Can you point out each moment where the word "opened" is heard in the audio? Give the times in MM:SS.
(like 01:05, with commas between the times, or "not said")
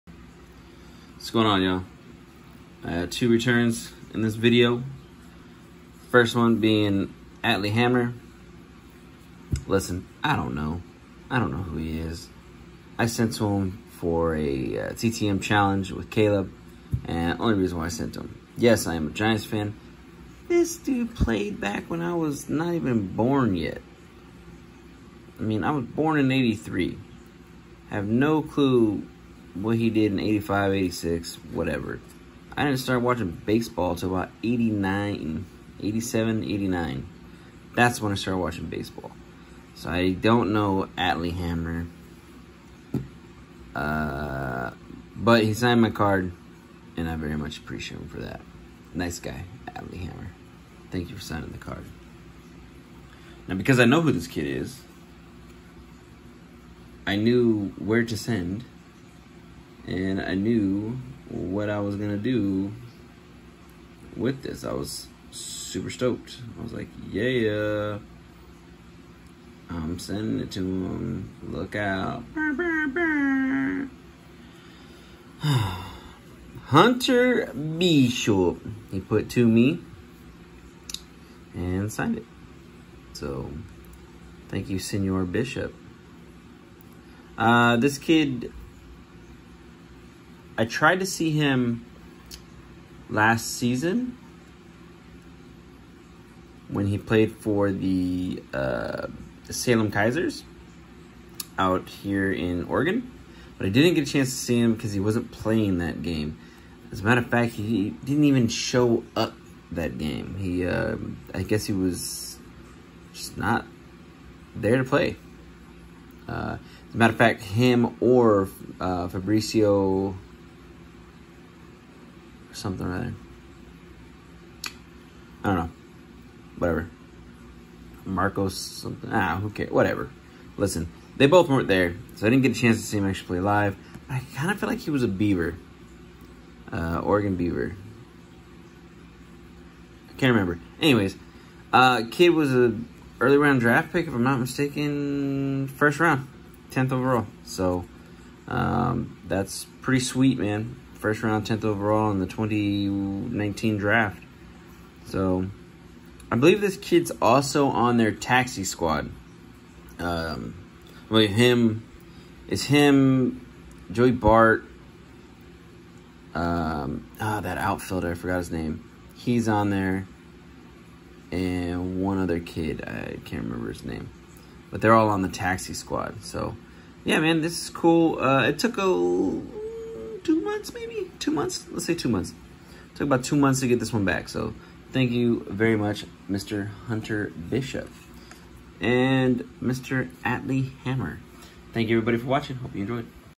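not said.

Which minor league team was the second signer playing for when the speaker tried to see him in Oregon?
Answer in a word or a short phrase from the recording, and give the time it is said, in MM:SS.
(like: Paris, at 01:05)
Salem Keizers, at 01:39.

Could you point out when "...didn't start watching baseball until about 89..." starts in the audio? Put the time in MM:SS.
00:32.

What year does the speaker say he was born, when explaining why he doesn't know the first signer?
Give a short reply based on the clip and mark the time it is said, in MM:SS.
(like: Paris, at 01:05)
1983, at 00:26.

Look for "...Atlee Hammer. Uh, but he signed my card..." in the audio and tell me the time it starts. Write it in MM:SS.
00:40.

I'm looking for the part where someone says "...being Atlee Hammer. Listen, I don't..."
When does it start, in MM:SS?
00:06.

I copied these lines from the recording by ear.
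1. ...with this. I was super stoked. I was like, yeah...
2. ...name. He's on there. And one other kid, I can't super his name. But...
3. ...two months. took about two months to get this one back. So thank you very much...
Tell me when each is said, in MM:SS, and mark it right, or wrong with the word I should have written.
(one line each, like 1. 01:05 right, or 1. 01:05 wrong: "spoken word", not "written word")
1. 01:04 right
2. 02:48 wrong: "remember", not "super"
3. 03:01 right.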